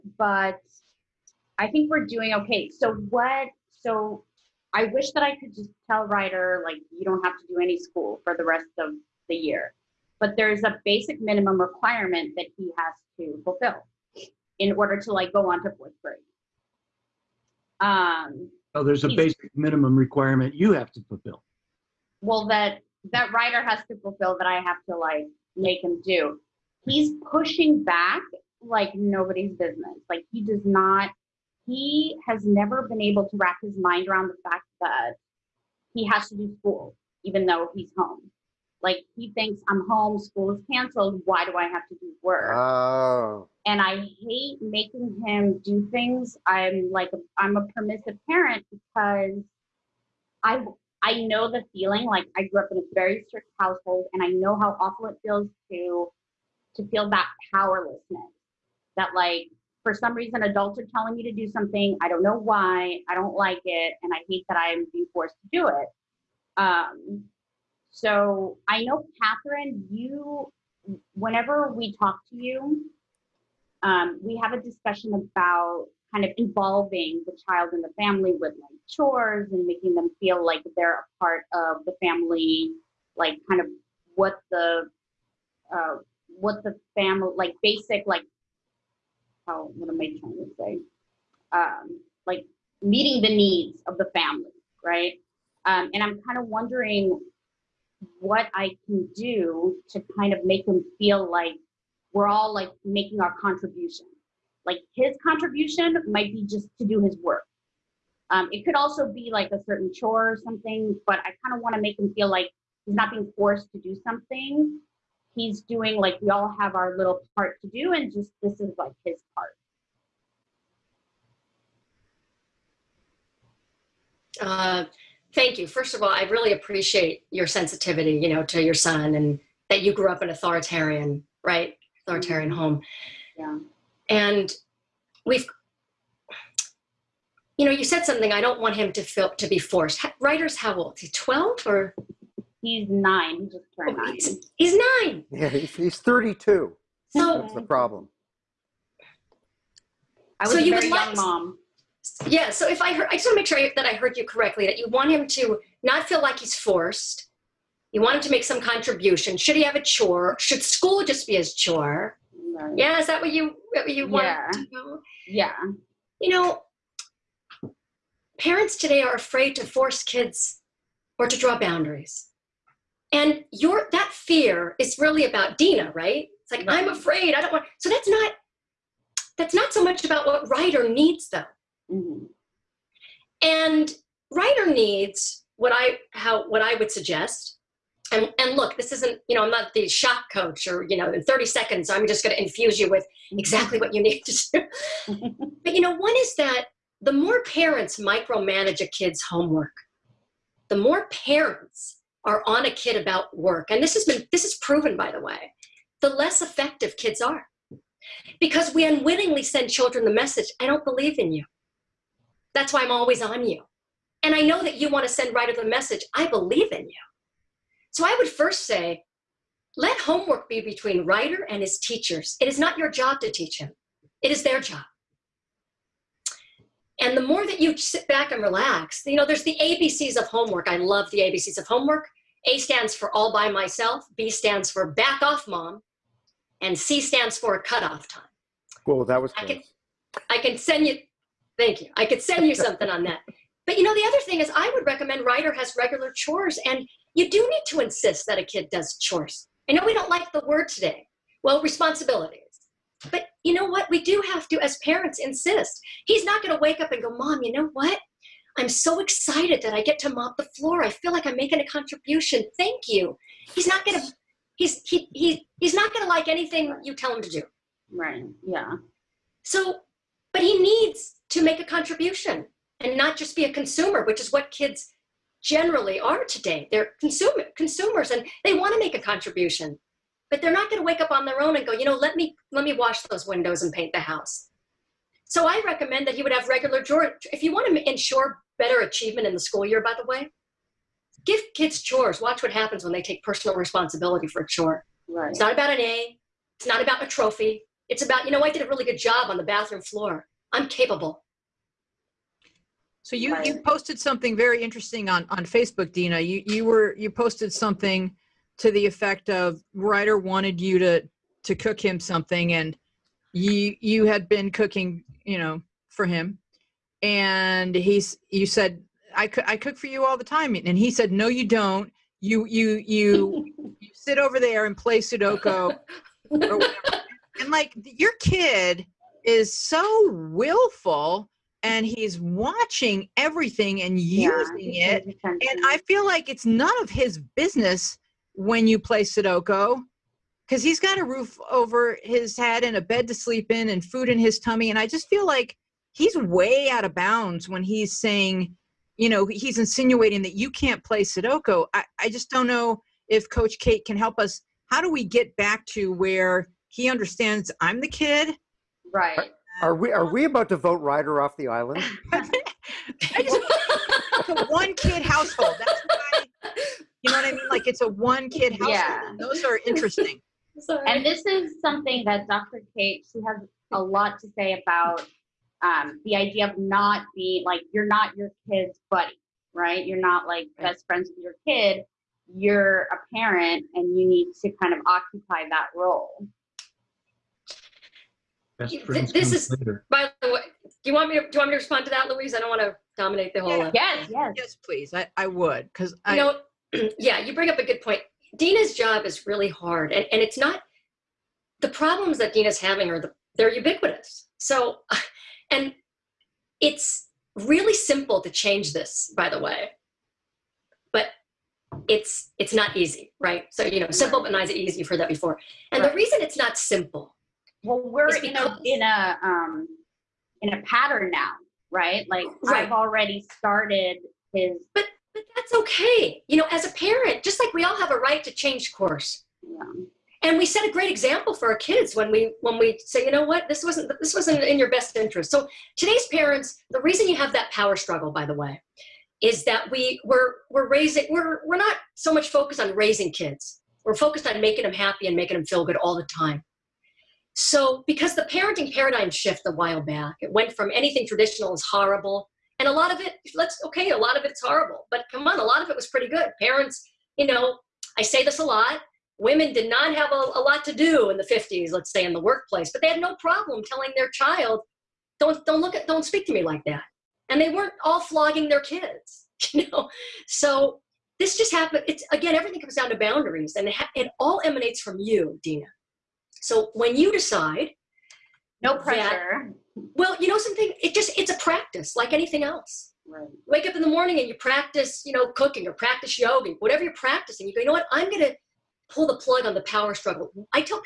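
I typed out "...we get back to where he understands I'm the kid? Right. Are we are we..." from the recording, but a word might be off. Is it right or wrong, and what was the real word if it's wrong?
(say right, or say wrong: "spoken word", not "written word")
right.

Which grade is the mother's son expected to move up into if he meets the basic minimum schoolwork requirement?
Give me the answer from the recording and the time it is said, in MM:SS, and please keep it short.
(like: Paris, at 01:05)
fourth grade, at 00:15.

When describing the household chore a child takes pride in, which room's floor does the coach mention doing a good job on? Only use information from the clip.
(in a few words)
bathroom.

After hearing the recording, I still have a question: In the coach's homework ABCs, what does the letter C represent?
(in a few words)
Cutoff time.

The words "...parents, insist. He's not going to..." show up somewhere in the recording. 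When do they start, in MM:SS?
04:14.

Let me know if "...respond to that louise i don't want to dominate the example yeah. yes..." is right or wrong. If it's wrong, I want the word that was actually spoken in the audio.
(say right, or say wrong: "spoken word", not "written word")
wrong: "whole", not "example".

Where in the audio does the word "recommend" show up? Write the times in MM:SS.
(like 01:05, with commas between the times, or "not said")
04:04, 04:45.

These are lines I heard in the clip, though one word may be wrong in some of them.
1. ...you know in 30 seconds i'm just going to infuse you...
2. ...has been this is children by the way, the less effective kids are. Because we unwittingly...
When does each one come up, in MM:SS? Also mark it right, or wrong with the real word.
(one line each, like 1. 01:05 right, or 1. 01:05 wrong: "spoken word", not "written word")
1. 03:10 right
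2. 03:23 wrong: "proven", not "children".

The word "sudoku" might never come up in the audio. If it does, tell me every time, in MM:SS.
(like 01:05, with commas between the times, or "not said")
05:24, 05:39, 05:51.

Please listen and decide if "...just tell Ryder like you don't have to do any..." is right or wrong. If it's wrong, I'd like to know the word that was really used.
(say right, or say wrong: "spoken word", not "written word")
right.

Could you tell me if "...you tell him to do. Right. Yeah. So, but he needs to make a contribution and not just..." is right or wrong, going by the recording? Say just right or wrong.
right.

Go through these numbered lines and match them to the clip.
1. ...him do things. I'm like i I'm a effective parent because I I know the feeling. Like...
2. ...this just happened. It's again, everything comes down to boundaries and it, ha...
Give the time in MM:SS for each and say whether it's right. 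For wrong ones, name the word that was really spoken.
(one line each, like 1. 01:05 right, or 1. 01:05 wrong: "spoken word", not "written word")
1. 00:45 wrong: "permissive", not "effective"
2. 07:51 right.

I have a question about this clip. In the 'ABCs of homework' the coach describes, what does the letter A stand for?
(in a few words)
All by myself.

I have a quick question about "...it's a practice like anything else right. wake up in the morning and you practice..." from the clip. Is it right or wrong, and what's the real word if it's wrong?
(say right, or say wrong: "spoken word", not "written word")
right.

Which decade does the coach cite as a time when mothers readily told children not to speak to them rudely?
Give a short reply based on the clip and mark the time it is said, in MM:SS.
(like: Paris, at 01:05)
the 50s, at 07:41.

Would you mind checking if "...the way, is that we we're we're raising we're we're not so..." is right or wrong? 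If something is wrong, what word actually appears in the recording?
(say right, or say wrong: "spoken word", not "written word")
right.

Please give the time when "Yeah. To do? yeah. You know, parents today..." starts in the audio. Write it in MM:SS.
02:44.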